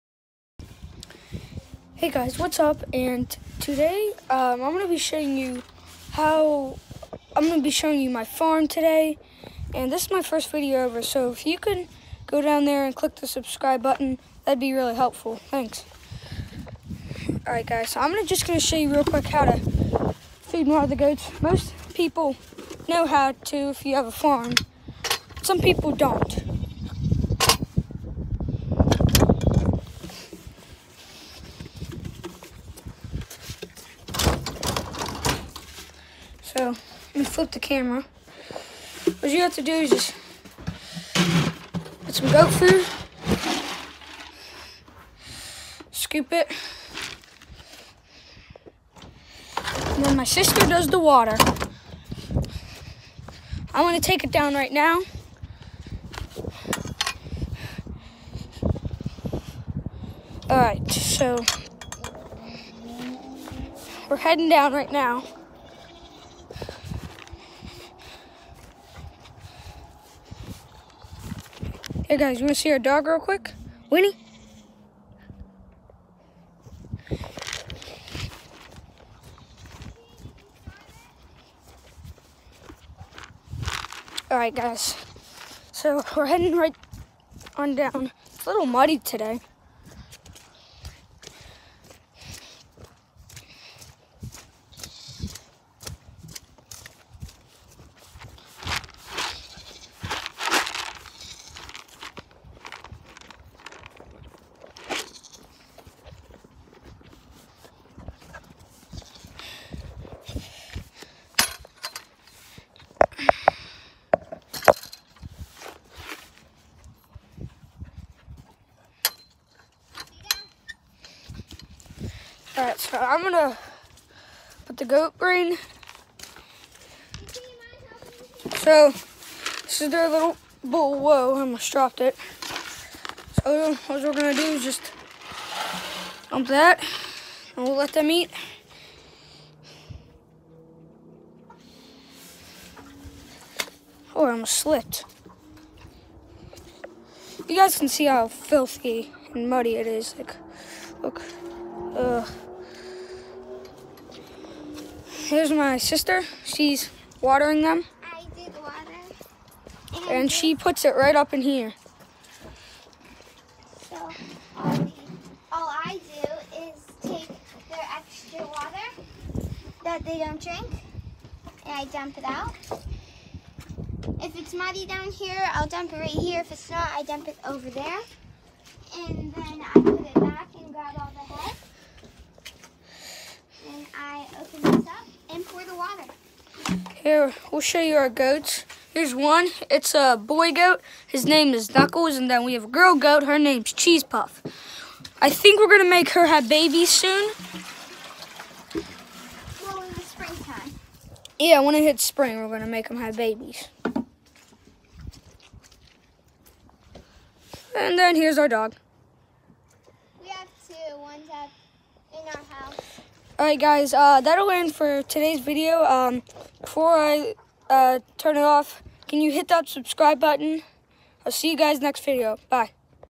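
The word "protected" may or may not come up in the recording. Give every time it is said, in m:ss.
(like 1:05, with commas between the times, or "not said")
not said.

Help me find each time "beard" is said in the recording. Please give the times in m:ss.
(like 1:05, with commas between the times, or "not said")
not said.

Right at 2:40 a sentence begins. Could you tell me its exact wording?
And, and she puts it right up in here.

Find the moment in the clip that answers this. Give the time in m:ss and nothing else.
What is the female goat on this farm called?
3:13.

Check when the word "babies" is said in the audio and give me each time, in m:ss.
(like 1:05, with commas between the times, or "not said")
3:16, 3:23.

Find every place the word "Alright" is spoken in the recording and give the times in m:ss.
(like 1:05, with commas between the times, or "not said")
1:24, 3:33.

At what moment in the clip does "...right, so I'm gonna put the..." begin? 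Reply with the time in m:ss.
2:02.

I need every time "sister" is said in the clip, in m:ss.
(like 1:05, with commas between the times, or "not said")
0:50, 2:35.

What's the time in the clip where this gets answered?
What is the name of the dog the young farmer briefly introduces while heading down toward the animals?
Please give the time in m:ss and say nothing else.
1:13.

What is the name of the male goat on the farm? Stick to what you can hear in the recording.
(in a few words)
Knuckles.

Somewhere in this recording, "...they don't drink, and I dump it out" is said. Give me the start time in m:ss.
2:50.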